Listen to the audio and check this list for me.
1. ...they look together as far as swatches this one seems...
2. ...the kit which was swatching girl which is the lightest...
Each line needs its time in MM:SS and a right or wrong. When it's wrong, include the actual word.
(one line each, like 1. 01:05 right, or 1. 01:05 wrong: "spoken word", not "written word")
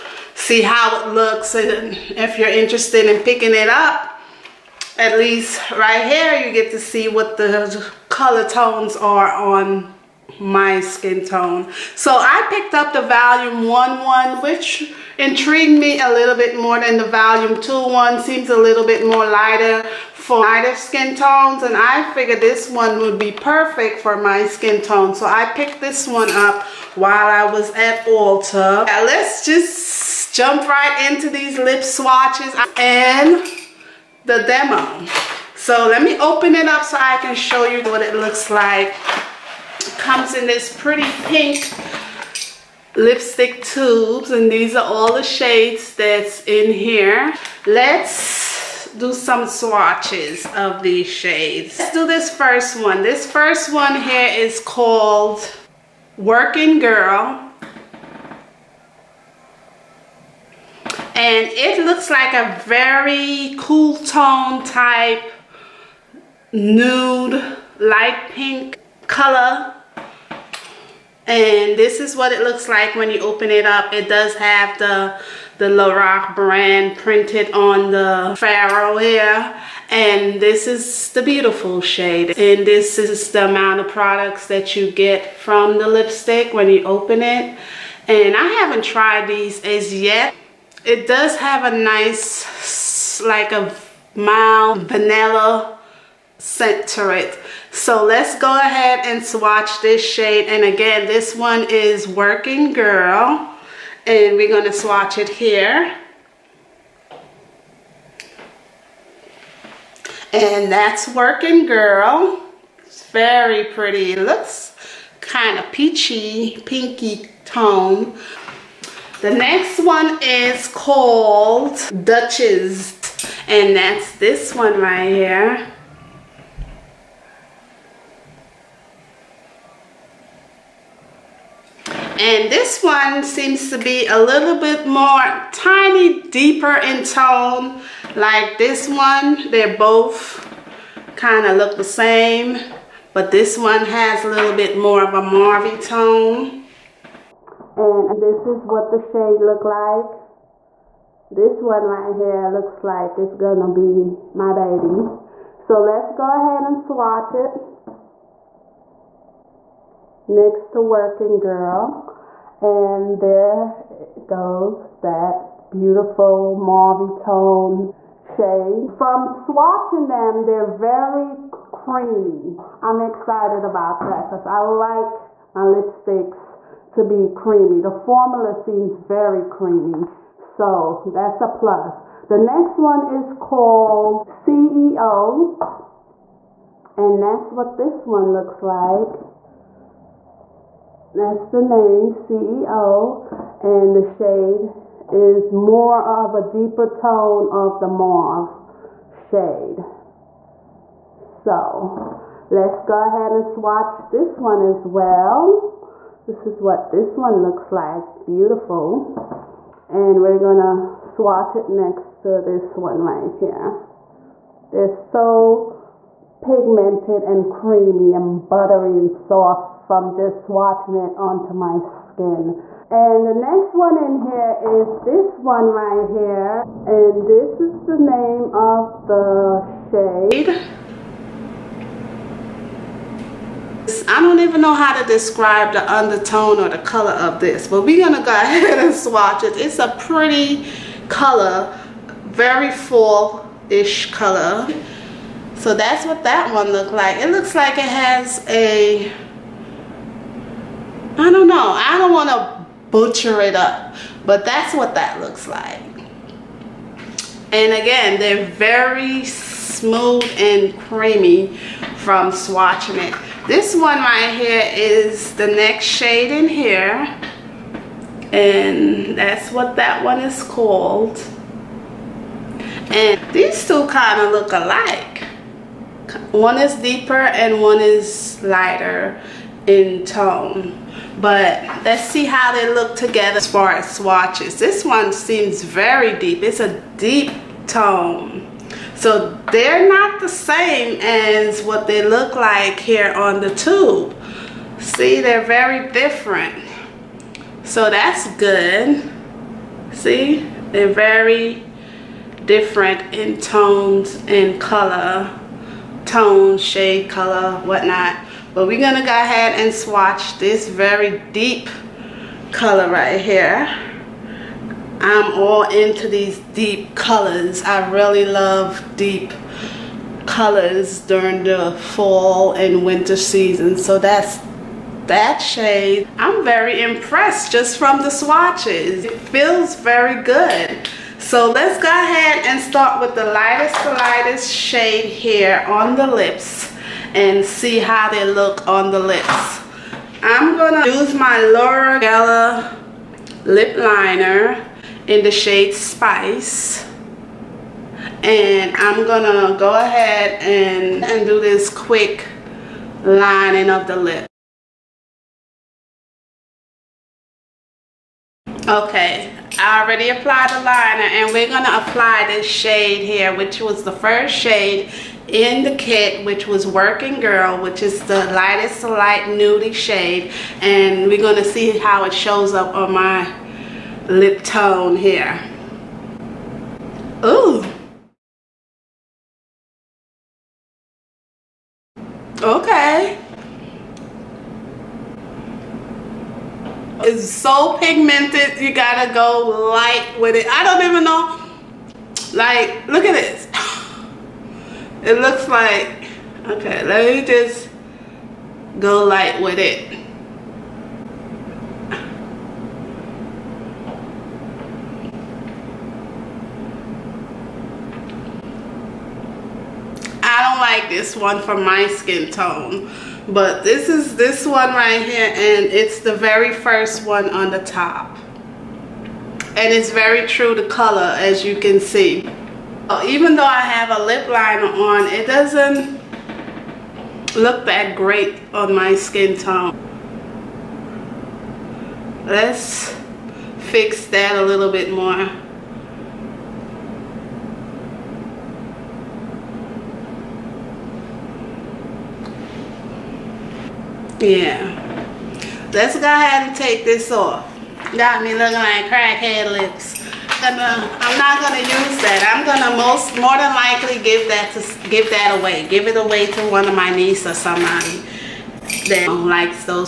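1. 04:42 right
2. 06:05 wrong: "working", not "swatching".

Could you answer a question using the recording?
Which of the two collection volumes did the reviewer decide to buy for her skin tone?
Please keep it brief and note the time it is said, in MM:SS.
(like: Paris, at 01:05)
Volume 1, at 00:13.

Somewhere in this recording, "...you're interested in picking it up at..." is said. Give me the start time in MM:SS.
00:02.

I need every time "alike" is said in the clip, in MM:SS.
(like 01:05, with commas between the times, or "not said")
04:34.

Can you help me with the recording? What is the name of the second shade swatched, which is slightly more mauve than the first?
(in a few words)
Duchess.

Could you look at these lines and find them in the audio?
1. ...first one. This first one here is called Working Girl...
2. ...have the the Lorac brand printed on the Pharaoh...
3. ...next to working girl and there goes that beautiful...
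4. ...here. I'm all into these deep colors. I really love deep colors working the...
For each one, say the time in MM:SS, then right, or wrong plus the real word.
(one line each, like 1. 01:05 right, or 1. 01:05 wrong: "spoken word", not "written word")
1. 00:52 right
2. 01:14 right
3. 02:40 right
4. 05:13 wrong: "during", not "working".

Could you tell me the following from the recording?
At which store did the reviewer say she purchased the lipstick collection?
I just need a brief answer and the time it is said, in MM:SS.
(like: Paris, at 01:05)
Ulta, at 00:28.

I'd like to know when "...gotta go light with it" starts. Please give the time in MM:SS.
06:28.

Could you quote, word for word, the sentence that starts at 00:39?
Comes in this pretty pink lipstick tubes and these are all the shades that's in here.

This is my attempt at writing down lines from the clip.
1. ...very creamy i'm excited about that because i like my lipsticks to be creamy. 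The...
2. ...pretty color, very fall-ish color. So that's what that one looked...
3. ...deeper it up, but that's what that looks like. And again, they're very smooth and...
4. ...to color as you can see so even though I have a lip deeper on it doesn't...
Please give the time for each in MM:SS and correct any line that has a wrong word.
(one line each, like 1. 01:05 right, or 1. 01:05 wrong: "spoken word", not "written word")
1. 02:50 right
2. 03:59 right
3. 04:12 wrong: "butcher", not "deeper"
4. 07:00 wrong: "liner", not "deeper".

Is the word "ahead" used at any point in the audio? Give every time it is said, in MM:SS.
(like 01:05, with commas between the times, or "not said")
01:38, 02:36, 03:23, 03:58, 05:09, 05:31, 05:49, 07:26.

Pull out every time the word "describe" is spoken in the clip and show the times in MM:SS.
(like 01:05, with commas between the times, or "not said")
03:55.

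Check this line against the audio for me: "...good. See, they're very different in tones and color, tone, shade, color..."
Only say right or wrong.
right.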